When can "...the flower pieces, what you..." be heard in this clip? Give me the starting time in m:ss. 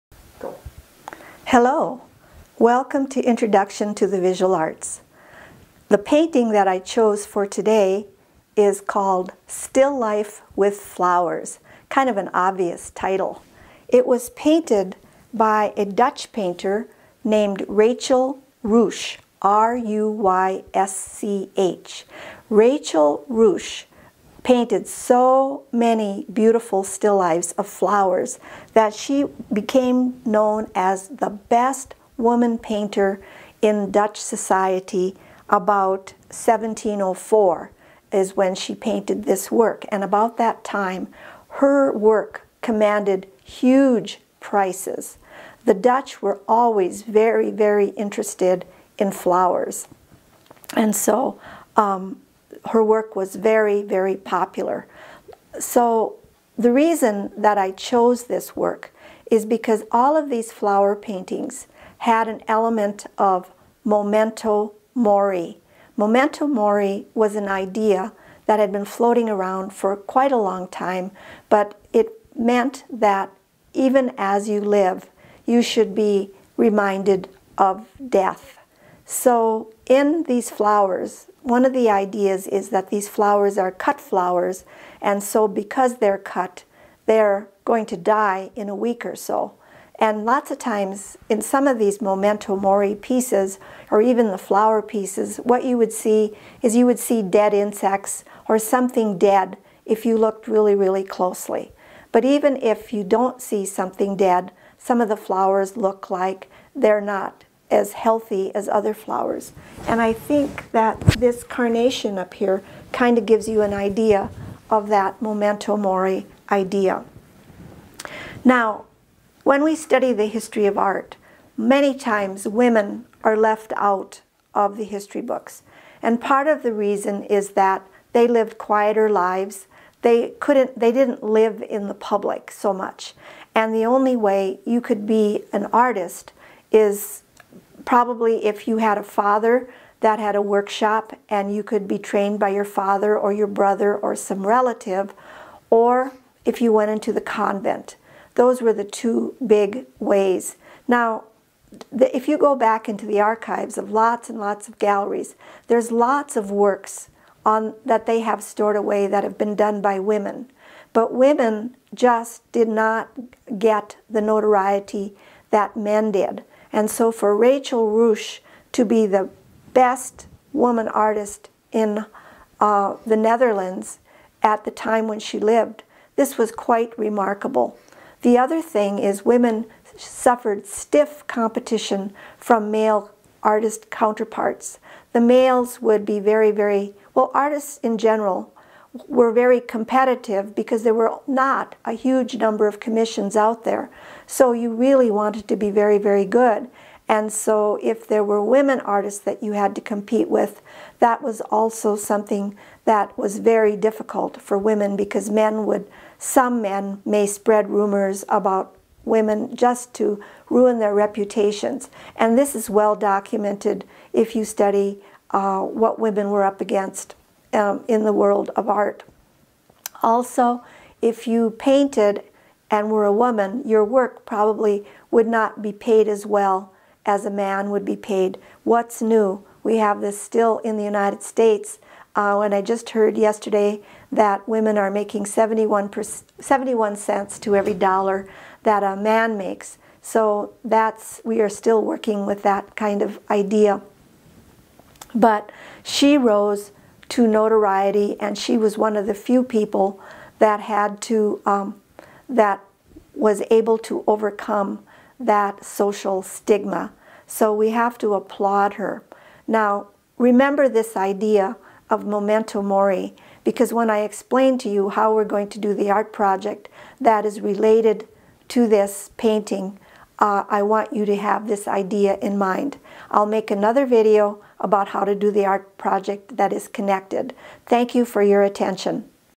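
1:34.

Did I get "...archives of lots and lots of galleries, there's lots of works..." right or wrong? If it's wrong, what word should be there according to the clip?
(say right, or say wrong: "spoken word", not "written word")
right.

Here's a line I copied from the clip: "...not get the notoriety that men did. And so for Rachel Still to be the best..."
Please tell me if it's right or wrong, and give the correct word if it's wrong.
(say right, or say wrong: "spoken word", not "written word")
wrong: "Ruysch", not "Still".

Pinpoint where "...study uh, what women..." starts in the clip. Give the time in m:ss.
3:34.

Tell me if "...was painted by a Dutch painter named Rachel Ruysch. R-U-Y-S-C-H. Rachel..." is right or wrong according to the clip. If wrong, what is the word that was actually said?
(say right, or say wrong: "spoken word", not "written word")
right.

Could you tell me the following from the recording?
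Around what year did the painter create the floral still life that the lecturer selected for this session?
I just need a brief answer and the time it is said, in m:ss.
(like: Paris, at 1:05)
1704, at 0:36.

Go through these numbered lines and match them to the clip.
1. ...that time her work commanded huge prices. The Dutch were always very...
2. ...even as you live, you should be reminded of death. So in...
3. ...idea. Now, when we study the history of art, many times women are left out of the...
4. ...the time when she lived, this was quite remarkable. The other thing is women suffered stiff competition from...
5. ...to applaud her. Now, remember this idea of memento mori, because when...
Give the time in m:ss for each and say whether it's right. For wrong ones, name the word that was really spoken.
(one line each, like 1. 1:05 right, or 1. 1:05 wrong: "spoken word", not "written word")
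1. 0:40 right
2. 1:13 right
3. 1:56 right
4. 2:54 right
5. 4:17 right.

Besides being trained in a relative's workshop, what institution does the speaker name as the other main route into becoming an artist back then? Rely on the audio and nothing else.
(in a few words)
The convent.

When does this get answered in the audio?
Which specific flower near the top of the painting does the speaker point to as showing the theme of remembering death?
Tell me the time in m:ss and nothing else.
1:51.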